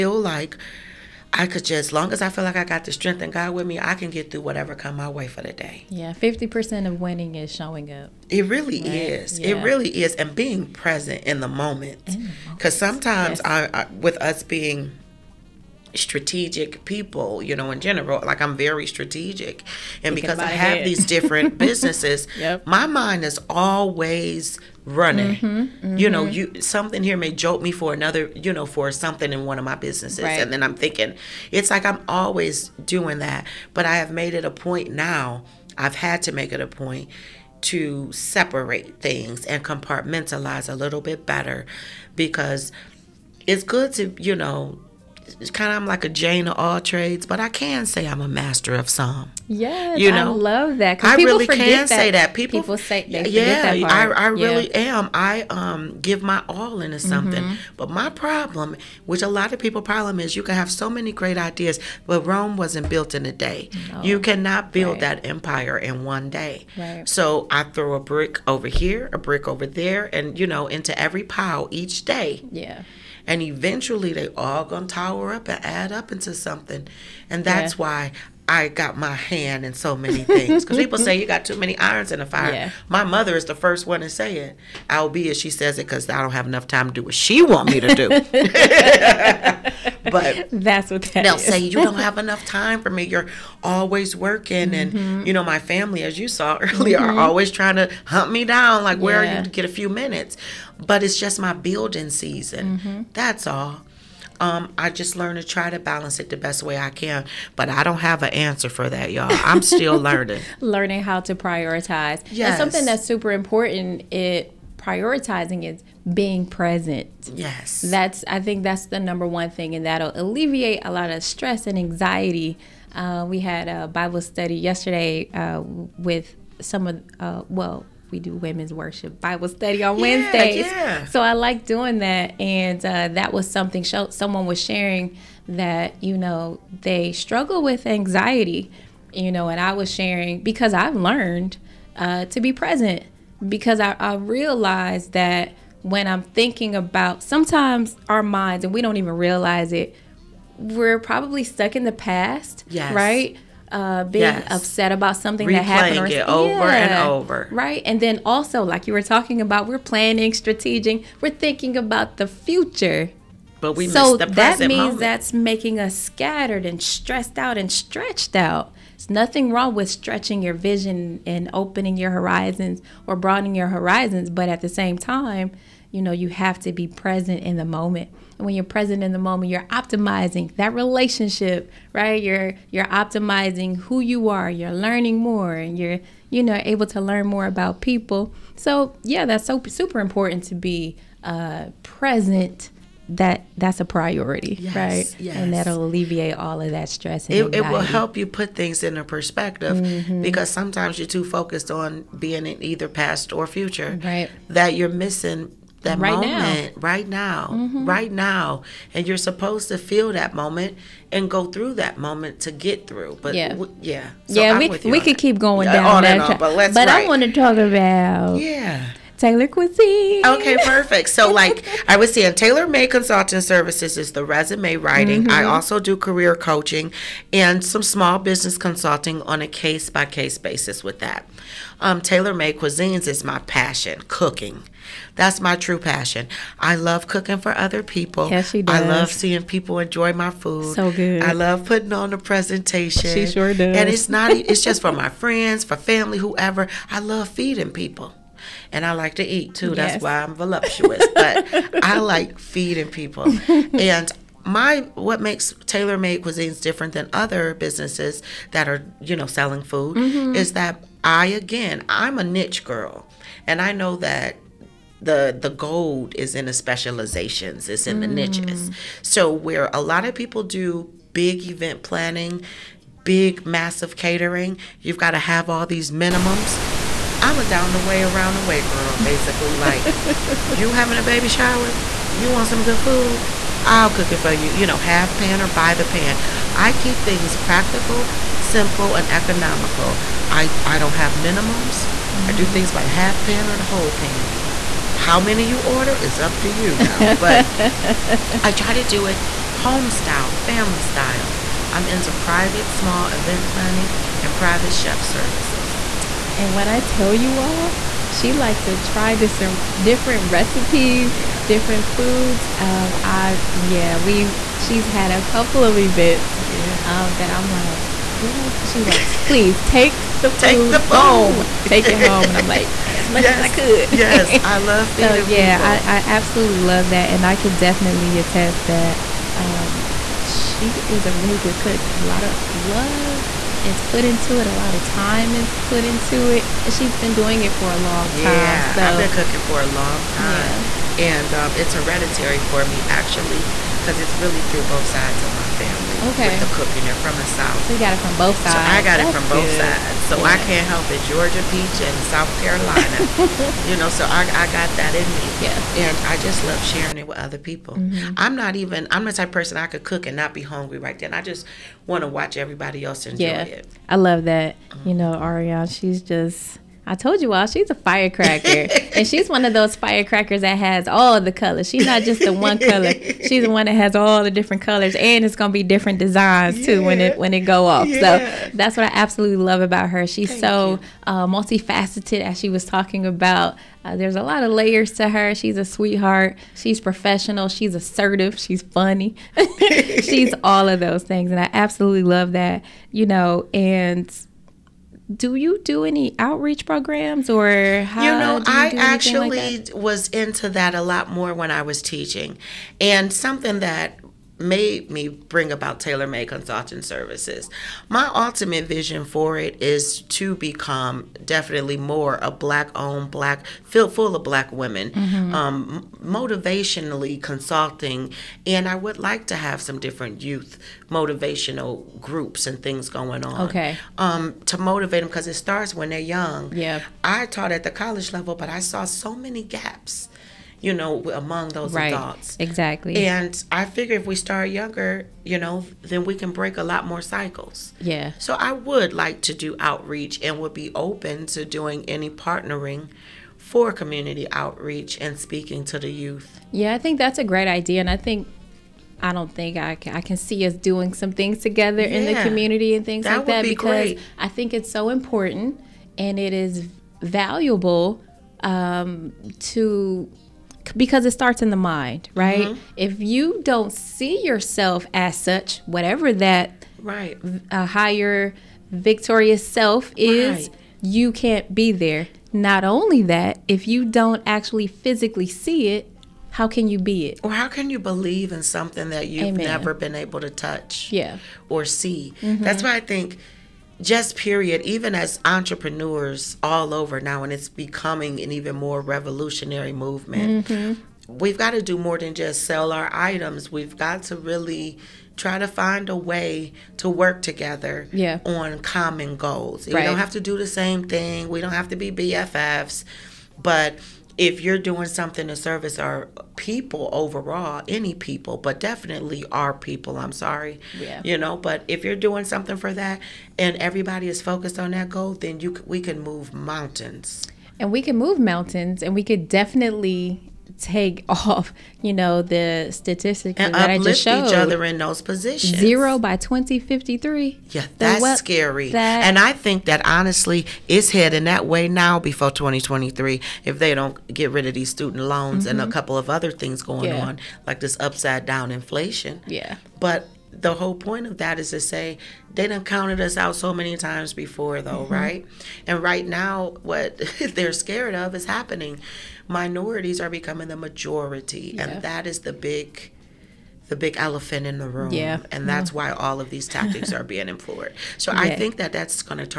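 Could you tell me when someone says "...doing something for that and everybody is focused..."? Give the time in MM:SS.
08:31.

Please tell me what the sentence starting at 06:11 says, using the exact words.
She's not just the one color.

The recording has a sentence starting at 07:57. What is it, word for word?
Or how can you believe in something that you've Amen.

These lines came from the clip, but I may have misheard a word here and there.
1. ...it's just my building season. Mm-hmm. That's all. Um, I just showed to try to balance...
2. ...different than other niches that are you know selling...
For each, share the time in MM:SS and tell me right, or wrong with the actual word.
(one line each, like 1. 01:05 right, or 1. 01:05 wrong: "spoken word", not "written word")
1. 01:41 wrong: "learned", not "showed"
2. 04:16 wrong: "businesses", not "niches".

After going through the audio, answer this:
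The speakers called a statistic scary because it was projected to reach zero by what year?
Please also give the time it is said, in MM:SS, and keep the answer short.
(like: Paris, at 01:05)
2053, at 08:46.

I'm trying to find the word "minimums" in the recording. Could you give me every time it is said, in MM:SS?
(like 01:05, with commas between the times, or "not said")
04:35, 04:51.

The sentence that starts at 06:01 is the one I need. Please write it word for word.
I just want to watch everybody else enjoy yeah, it.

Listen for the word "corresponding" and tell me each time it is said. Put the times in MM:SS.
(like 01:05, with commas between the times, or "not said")
not said.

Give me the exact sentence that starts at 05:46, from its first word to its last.
Okay, with the cooking, they're from the south.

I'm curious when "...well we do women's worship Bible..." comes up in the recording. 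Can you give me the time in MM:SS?
02:07.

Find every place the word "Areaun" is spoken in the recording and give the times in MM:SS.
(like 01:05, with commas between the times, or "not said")
06:05.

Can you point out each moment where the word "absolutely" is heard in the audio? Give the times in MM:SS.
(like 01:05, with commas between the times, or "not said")
05:26, 06:18, 06:31.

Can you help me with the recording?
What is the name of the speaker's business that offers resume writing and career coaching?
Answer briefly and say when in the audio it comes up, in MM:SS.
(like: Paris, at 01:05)
Taylor Made Consulting Services, at 03:42.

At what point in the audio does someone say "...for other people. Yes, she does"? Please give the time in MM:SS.
03:57.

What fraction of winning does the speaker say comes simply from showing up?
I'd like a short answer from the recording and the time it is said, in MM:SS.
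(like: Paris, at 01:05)
50 percent, at 00:06.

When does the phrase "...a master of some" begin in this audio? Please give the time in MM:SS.
00:48.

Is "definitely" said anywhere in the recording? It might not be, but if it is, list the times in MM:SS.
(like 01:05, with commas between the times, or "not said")
05:27, 06:51, 08:28, 08:39.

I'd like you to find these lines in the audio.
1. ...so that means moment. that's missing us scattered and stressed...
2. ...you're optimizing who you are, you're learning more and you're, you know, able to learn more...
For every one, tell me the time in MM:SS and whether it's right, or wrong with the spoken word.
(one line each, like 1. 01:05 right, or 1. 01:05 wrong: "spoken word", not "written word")
1. 02:43 wrong: "making", not "missing"
2. 03:02 right.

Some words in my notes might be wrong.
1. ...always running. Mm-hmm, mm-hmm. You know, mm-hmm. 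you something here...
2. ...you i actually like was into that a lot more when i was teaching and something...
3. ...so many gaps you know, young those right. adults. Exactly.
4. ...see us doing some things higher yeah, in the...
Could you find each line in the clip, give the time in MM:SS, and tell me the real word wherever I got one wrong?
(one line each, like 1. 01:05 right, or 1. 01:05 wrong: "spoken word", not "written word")
1. 00:23 right
2. 06:38 right
3. 07:08 wrong: "among", not "young"
4. 07:30 wrong: "together", not "higher".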